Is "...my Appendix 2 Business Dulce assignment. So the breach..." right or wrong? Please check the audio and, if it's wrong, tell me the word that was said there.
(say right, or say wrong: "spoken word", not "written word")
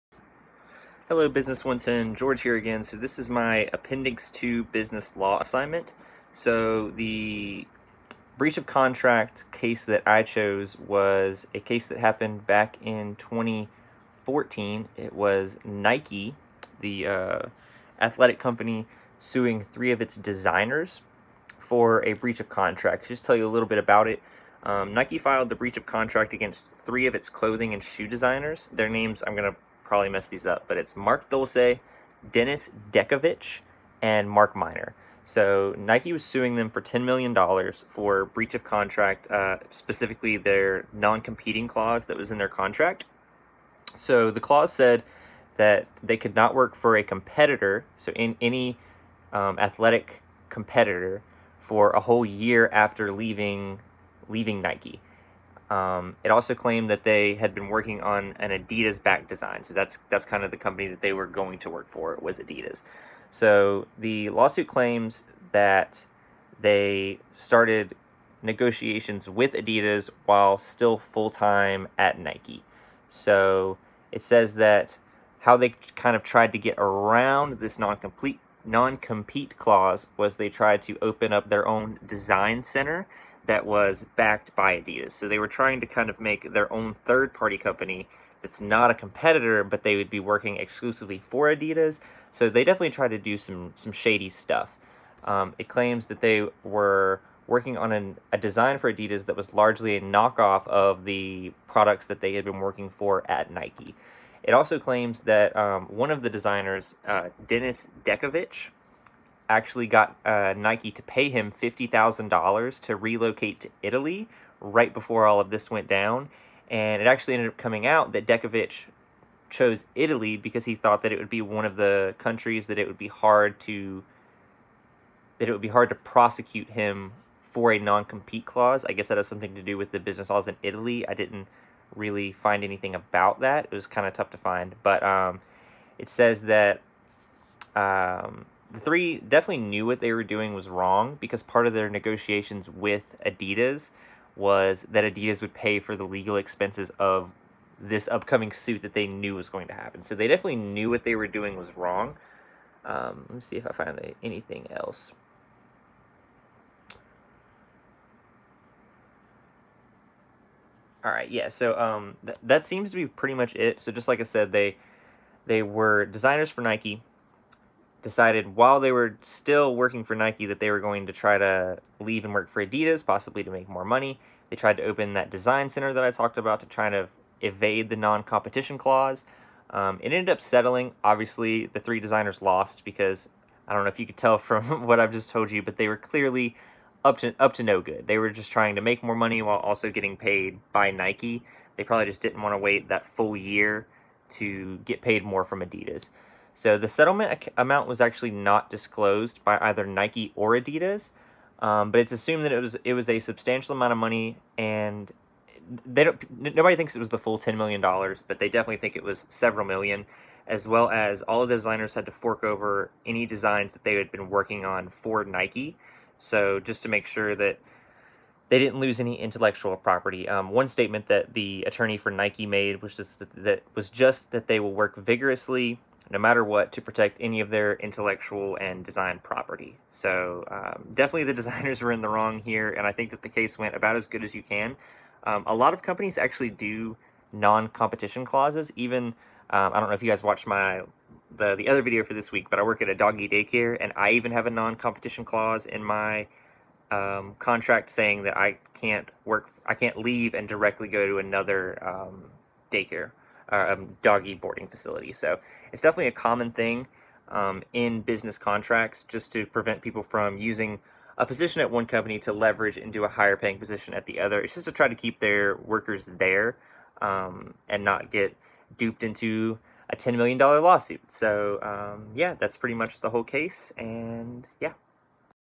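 wrong: "Law", not "Dulce".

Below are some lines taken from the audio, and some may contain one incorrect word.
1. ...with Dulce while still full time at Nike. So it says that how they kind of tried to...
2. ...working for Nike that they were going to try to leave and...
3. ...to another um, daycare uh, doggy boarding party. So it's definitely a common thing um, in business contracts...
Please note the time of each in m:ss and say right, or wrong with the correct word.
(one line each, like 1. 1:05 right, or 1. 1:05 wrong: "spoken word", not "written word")
1. 1:09 wrong: "Adidas", not "Dulce"
2. 2:49 right
3. 4:11 wrong: "facility", not "party".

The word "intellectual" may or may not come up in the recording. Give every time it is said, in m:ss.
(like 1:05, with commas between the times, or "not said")
3:39, 3:47.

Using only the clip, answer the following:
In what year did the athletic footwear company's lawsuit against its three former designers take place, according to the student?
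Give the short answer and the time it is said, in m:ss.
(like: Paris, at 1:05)
2014, at 0:13.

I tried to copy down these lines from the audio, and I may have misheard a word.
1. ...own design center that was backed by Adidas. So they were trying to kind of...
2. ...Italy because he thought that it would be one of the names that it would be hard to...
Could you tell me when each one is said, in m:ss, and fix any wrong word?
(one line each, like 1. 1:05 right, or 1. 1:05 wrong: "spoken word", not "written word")
1. 1:21 right
2. 1:59 wrong: "countries", not "names".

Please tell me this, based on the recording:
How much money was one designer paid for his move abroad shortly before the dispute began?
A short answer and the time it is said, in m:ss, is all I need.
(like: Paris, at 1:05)
$50,000, at 1:51.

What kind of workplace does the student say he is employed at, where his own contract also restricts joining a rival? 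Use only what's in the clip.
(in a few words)
A doggy daycare.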